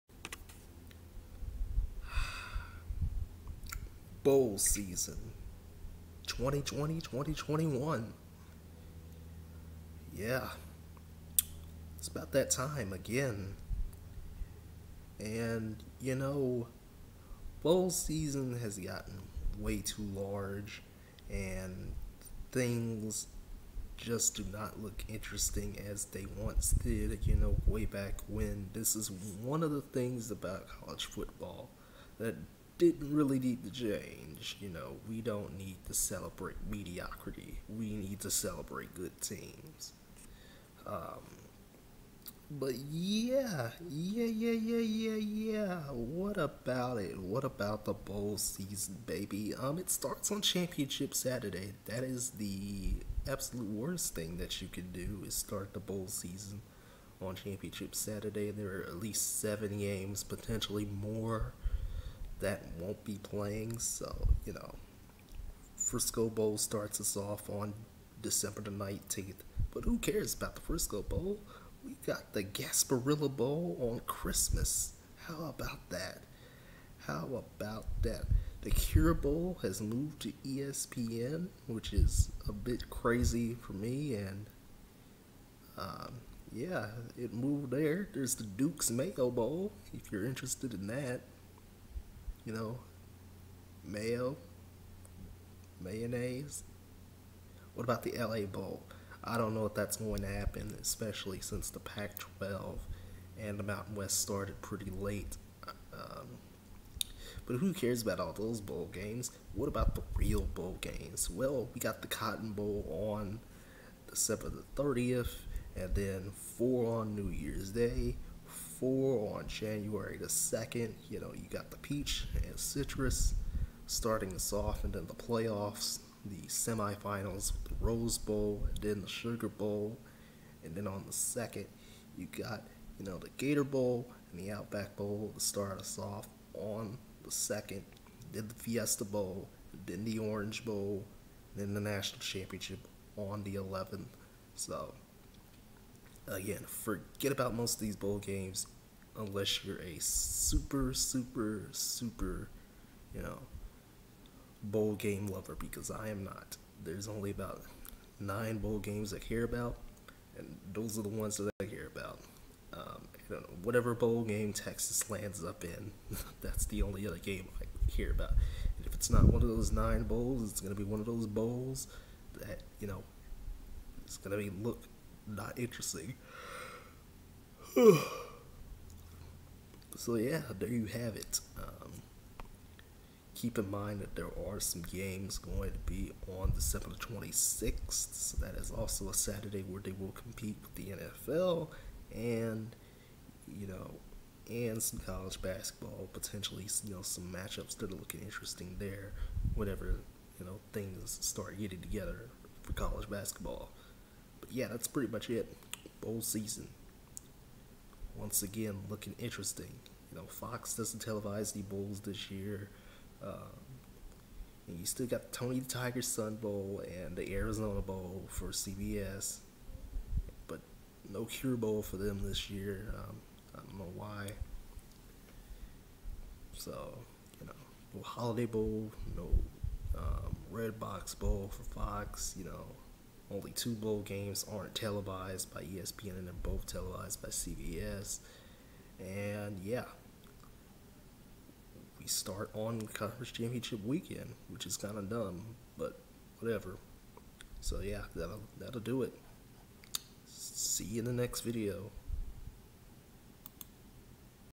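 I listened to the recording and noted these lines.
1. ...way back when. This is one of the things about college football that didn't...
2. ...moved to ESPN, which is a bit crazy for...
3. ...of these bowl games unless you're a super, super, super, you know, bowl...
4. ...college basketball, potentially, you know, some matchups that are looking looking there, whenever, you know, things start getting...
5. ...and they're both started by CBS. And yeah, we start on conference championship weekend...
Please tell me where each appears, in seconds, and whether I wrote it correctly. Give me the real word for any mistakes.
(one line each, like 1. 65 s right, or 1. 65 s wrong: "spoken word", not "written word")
1. 27 s right
2. 79 s right
3. 147 s right
4. 195 s wrong: "interesting", not "looking"
5. 236 s wrong: "televised", not "started".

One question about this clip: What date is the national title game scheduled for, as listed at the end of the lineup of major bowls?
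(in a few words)
the 11th.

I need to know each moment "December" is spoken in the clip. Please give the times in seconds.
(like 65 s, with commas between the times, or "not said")
68 s, 114 s, 186 s.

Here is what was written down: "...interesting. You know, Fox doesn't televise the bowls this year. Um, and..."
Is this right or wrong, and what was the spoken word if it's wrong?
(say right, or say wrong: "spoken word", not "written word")
right.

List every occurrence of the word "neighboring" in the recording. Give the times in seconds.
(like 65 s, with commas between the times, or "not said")
not said.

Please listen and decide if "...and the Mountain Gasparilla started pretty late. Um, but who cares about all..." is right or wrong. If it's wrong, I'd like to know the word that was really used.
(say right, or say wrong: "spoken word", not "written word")
wrong: "West", not "Gasparilla".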